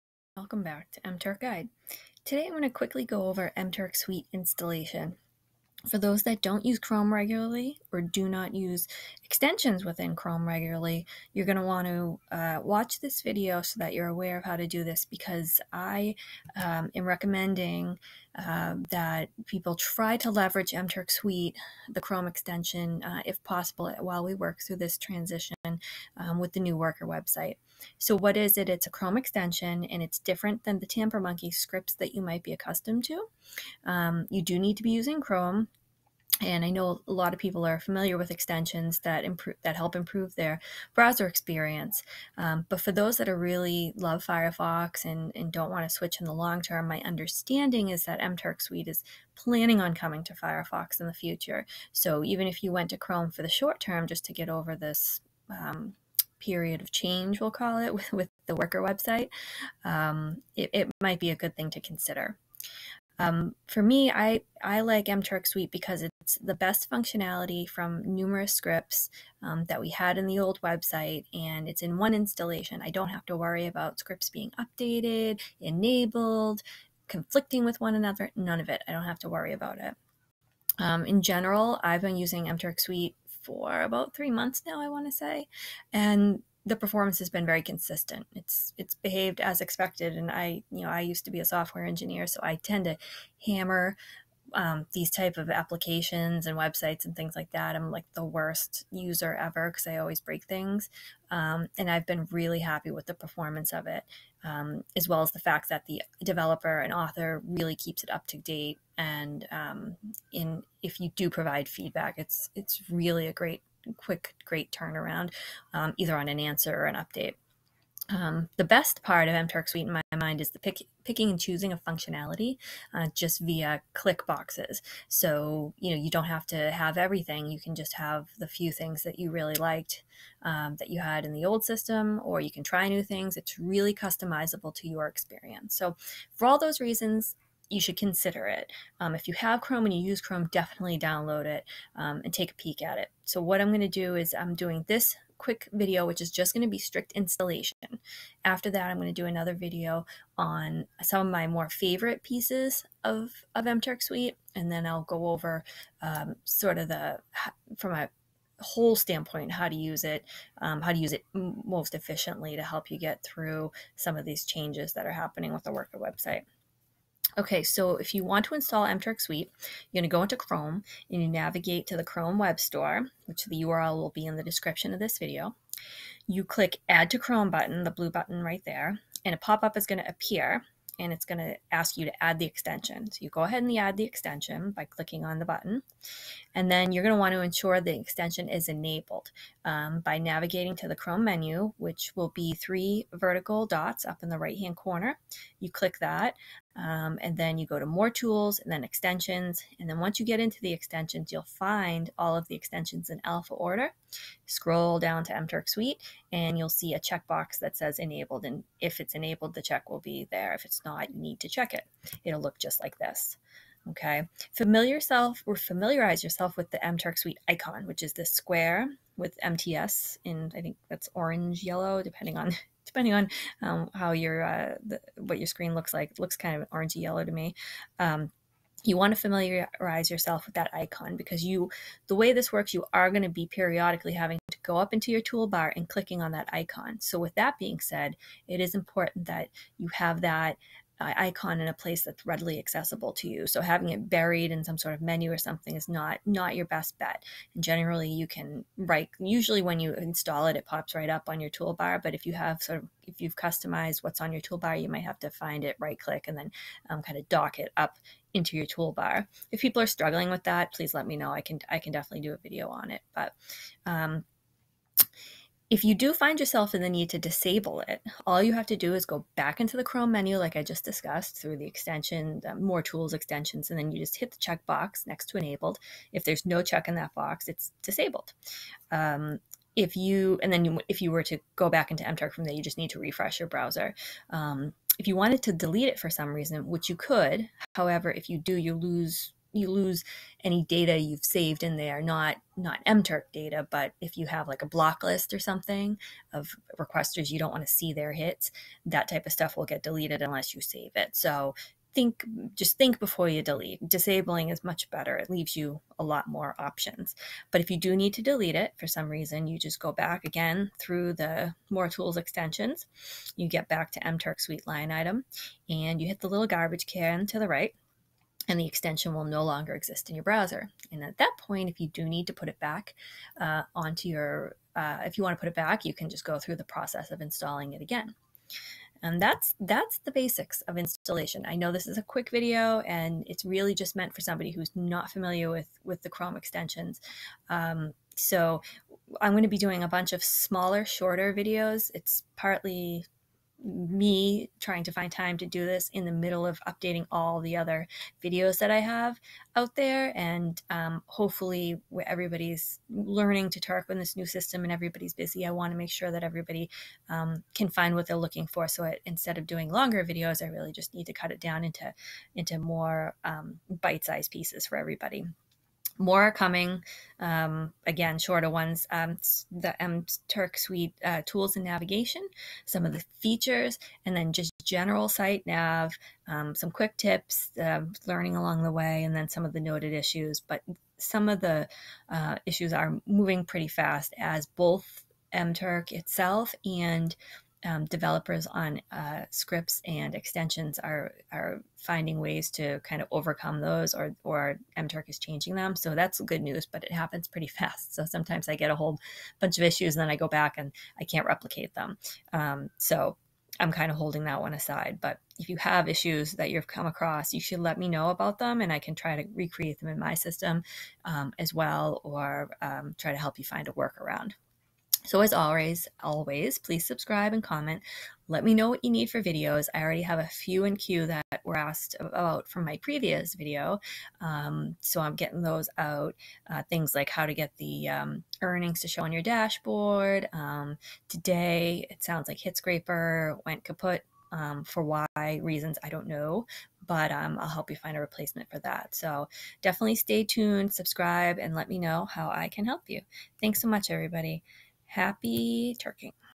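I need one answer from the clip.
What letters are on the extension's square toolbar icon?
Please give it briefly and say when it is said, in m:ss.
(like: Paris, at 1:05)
MTS, at 3:39.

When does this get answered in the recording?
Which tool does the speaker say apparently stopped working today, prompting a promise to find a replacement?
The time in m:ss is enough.
7:12.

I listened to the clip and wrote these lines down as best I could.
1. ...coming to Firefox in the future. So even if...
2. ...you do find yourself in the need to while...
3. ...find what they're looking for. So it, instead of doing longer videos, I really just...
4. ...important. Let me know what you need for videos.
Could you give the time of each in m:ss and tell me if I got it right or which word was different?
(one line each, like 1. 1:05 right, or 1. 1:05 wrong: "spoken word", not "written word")
1. 0:49 right
2. 4:25 wrong: "disable", not "while"
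3. 5:57 right
4. 6:57 wrong: "comment", not "important".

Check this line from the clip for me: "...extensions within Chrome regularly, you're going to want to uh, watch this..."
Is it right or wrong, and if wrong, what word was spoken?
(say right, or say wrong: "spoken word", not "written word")
right.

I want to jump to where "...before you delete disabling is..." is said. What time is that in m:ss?
5:02.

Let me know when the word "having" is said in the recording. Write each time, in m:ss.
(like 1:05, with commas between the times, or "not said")
3:54, 4:03.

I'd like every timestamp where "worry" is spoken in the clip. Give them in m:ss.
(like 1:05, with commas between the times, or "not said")
1:13, 1:19.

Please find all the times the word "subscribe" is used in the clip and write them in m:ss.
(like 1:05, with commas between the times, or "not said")
6:56, 7:20.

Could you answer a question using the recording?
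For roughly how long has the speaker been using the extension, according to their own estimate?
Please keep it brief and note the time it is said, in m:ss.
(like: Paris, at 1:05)
About three months, at 1:23.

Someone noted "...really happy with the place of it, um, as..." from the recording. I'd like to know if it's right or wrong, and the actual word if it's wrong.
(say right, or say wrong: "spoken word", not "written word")
wrong: "performance", not "place".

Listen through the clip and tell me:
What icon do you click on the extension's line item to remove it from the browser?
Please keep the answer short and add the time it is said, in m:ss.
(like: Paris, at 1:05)
Garbage can, at 5:16.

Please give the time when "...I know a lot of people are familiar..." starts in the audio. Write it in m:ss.
0:36.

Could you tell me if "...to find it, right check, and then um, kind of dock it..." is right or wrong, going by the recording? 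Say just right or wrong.
wrong.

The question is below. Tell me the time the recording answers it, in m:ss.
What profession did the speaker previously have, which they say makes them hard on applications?
1:31.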